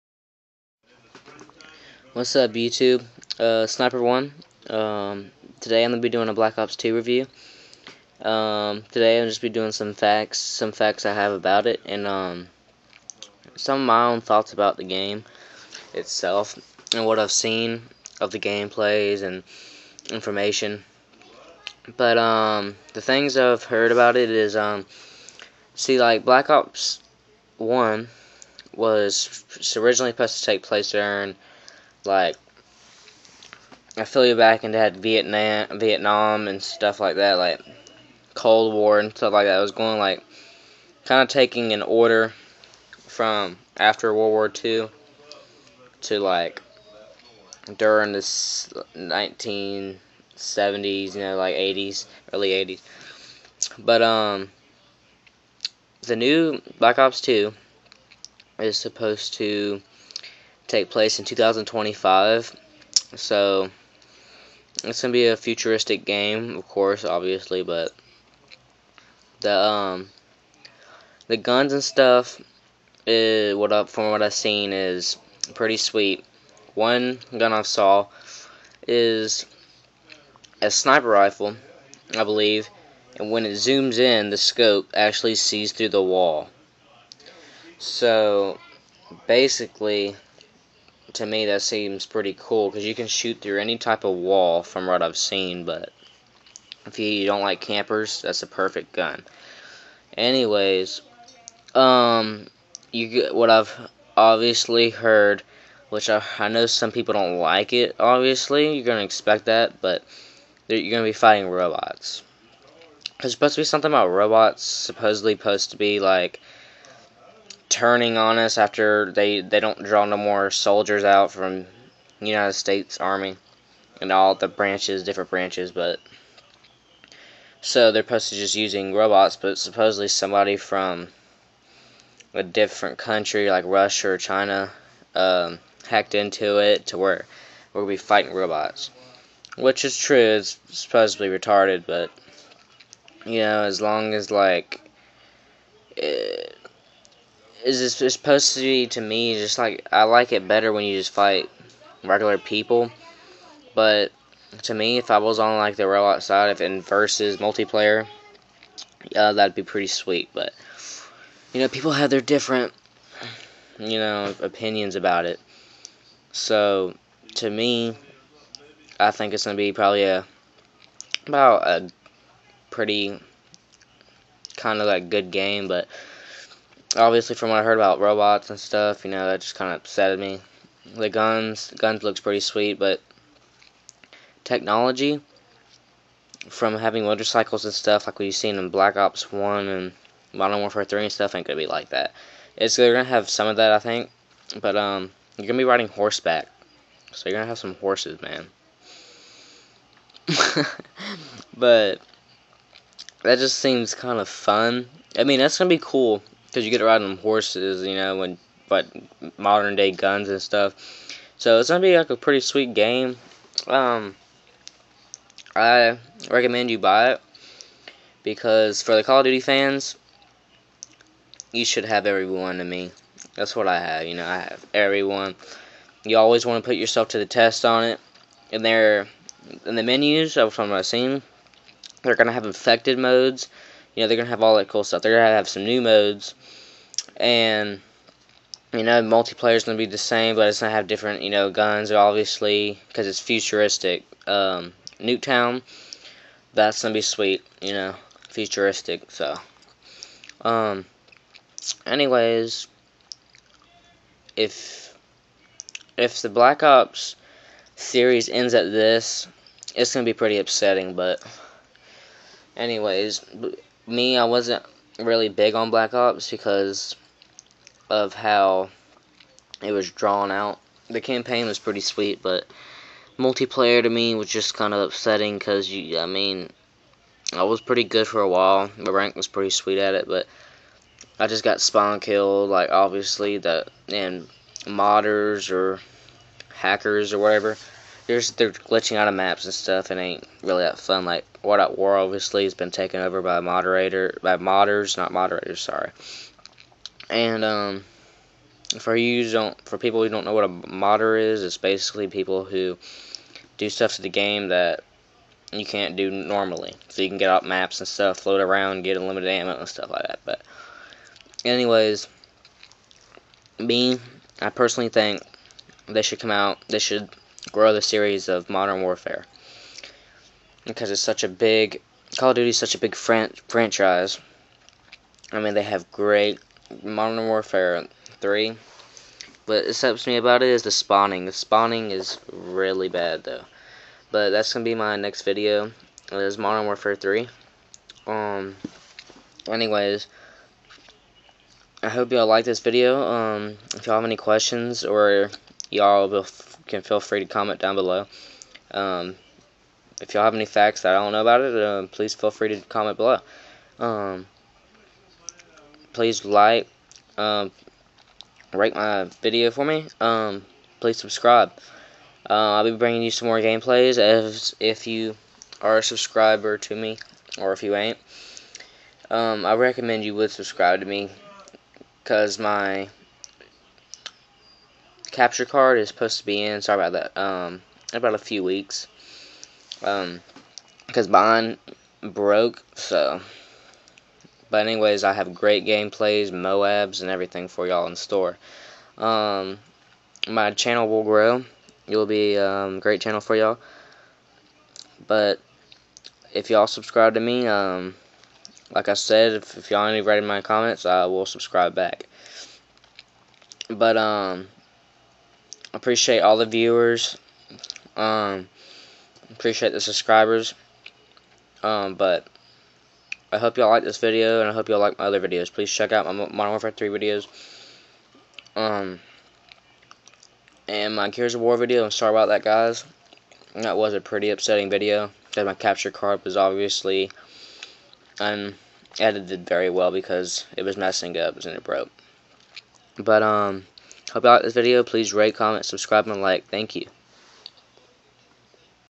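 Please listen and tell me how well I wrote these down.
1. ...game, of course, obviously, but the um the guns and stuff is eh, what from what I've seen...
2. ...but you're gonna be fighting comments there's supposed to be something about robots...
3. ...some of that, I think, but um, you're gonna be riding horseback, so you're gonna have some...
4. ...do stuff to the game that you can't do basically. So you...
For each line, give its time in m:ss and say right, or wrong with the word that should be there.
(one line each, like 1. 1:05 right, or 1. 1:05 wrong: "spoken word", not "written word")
1. 1:06 right
2. 1:49 wrong: "robots", not "comments"
3. 3:13 right
4. 5:03 wrong: "normally", not "basically".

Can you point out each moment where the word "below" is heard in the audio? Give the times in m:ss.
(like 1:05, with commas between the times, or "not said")
5:47, 5:52.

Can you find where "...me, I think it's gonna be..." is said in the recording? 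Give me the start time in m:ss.
2:47.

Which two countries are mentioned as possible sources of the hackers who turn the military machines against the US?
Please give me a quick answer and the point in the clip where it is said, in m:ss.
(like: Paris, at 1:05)
Russia or China, at 2:13.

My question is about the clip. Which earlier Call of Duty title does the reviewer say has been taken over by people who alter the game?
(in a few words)
World at War.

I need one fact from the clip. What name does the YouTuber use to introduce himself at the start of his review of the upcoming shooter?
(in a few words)
Sniper1.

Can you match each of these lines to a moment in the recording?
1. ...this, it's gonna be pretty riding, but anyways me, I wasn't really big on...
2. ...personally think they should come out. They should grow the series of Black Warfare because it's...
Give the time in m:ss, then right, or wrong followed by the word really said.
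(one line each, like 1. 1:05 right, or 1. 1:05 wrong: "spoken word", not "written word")
1. 4:18 wrong: "upsetting", not "riding"
2. 5:14 wrong: "Modern", not "Black".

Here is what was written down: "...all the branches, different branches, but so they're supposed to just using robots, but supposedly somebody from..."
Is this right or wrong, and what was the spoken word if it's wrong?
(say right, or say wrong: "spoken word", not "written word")
right.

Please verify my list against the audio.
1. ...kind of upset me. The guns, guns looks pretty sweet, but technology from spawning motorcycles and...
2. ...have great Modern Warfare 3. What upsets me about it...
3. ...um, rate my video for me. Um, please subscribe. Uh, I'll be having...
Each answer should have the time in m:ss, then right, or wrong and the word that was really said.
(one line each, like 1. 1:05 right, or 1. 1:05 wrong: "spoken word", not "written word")
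1. 2:59 wrong: "having", not "spawning"
2. 5:25 right
3. 5:57 wrong: "bringing", not "having".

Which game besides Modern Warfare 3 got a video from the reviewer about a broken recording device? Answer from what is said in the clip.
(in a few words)
Gears of War.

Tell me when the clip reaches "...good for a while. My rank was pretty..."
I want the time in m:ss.
4:37.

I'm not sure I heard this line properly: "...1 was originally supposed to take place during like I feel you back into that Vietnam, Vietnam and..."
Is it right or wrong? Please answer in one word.
right.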